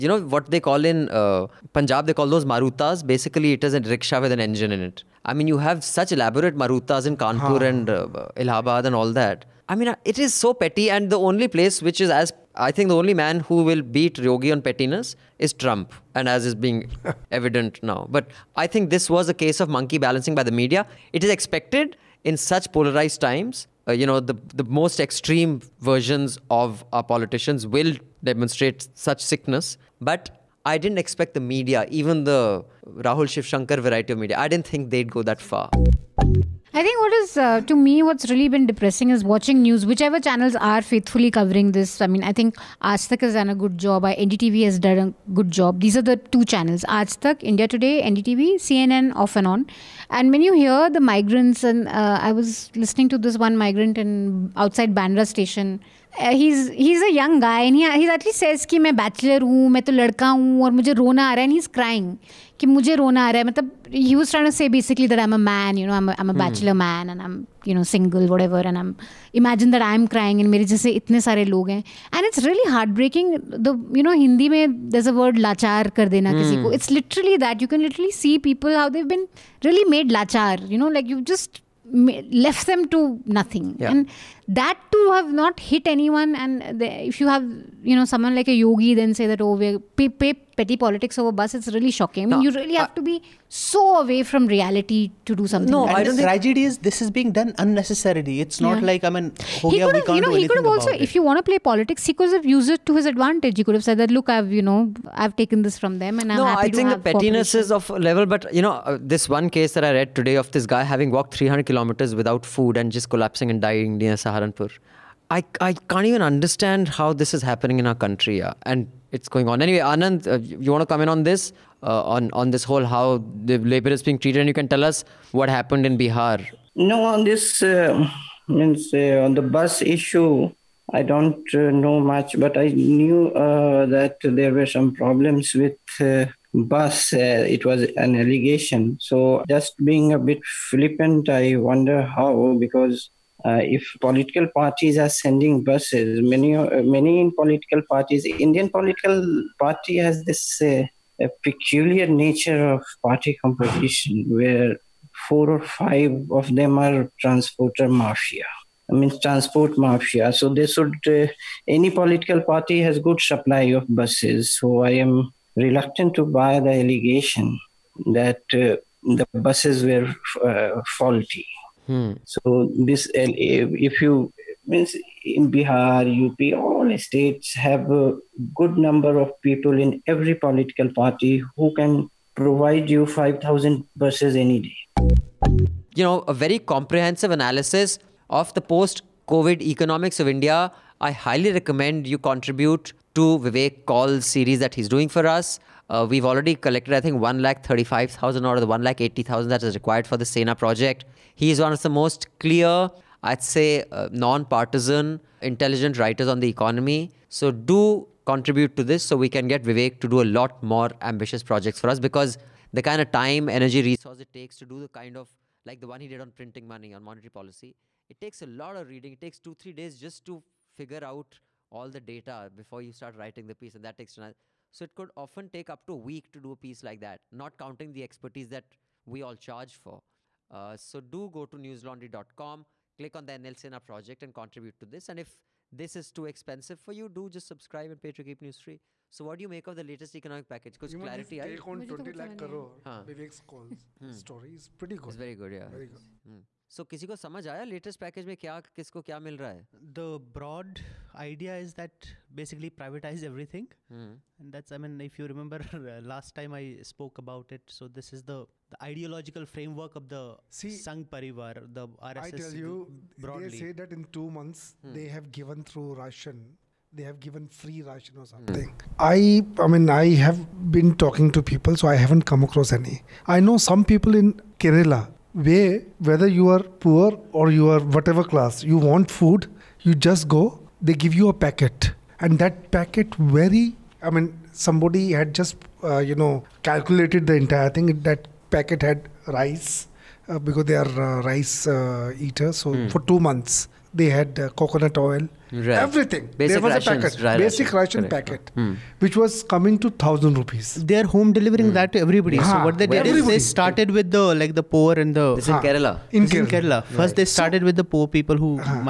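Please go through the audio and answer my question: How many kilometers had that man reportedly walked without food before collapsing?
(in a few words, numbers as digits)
300.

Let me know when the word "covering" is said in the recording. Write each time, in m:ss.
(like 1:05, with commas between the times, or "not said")
0:41.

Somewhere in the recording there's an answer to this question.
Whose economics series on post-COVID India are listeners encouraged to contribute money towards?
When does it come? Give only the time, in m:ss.
3:13.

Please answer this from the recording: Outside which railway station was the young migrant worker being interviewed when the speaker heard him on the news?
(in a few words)
Bandra.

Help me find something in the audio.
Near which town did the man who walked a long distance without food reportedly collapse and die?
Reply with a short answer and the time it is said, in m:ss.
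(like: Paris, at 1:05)
Saharanpur, at 1:54.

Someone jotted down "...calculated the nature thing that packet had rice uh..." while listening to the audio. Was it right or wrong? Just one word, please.
wrong.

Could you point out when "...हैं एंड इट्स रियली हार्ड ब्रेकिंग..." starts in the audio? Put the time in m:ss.
1:11.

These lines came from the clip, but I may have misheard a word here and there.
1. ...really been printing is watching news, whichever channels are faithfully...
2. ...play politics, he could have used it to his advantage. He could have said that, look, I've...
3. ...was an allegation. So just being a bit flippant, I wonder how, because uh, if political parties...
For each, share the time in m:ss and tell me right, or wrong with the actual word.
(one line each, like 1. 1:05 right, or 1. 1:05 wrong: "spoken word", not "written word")
1. 0:38 wrong: "depressing", not "printing"
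2. 1:41 right
3. 2:17 right.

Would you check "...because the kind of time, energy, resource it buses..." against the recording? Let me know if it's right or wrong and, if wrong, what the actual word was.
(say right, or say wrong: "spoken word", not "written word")
wrong: "takes", not "buses".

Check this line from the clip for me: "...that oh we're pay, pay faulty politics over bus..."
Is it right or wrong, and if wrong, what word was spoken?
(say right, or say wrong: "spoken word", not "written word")
wrong: "petty", not "faulty".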